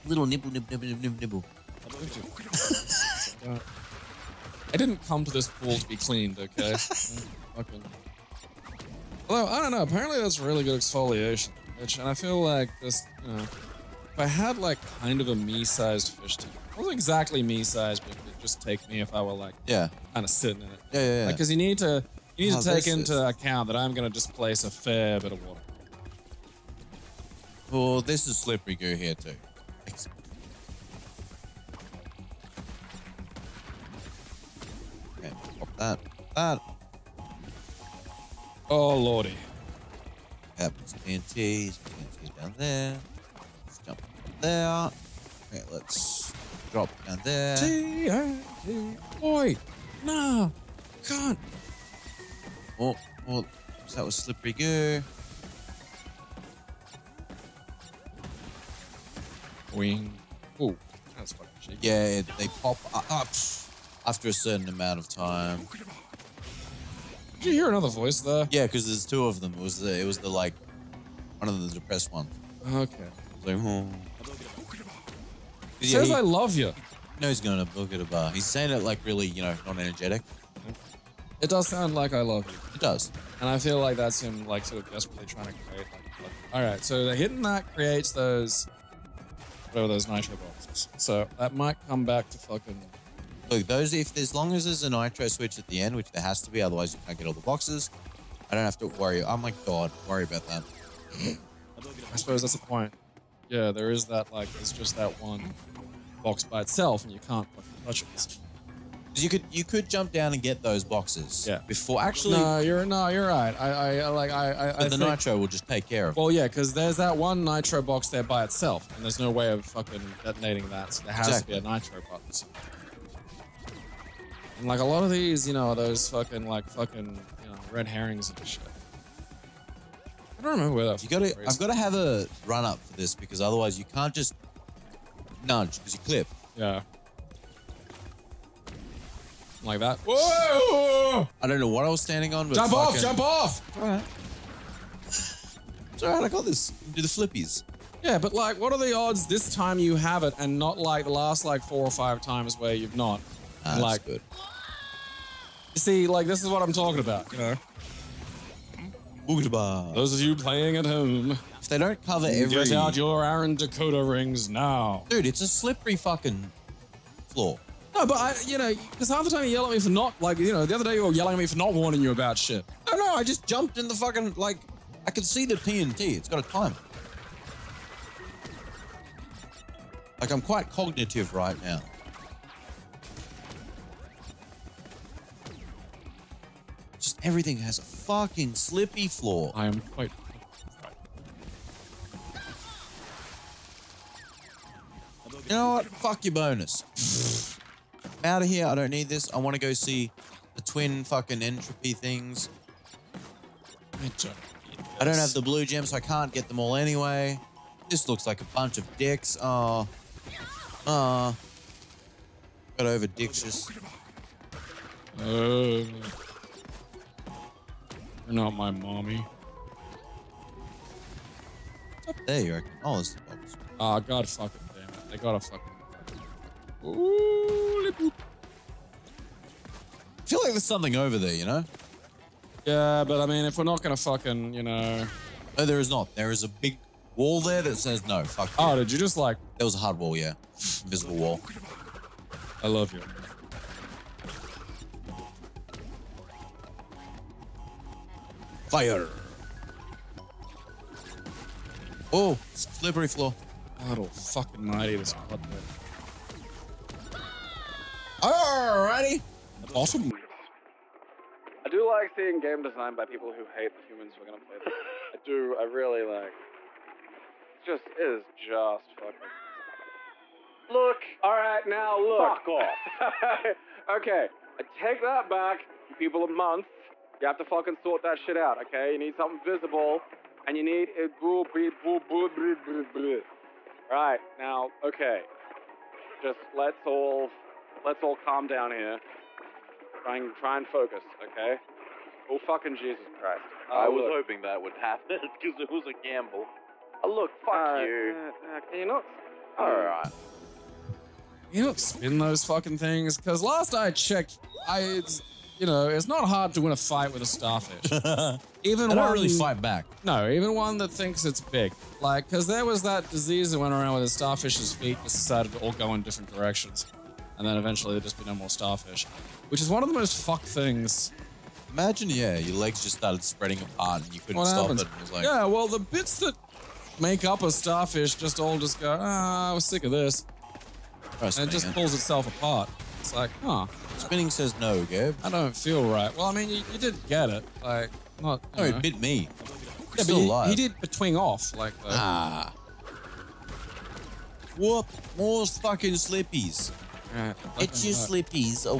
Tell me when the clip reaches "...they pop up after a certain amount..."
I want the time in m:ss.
1:02.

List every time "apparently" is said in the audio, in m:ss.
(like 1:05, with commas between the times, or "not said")
0:09.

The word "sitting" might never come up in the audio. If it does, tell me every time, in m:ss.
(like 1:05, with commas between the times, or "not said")
0:20.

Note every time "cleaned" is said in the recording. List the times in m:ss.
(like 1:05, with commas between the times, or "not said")
0:05.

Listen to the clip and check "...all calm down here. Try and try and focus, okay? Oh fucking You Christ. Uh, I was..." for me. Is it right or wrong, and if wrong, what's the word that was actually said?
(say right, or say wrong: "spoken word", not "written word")
wrong: "Jesus", not "You".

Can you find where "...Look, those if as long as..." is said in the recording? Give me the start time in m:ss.
1:33.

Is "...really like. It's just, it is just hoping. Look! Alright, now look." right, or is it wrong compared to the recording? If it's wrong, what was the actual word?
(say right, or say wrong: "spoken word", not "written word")
wrong: "fucking", not "hoping".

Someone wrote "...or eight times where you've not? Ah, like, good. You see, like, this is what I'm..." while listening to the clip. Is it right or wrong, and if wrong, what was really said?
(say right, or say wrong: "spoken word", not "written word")
wrong: "five", not "eight".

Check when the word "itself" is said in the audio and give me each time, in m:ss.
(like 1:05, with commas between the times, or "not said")
1:46, 1:58, 5:31.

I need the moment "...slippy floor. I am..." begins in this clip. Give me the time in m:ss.
3:08.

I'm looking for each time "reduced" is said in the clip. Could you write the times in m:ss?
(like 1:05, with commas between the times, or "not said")
not said.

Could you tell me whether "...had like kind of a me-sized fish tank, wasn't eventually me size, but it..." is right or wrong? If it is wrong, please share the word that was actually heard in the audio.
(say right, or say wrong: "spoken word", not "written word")
wrong: "exactly", not "eventually".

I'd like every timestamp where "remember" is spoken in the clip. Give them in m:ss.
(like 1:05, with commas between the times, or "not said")
2:10.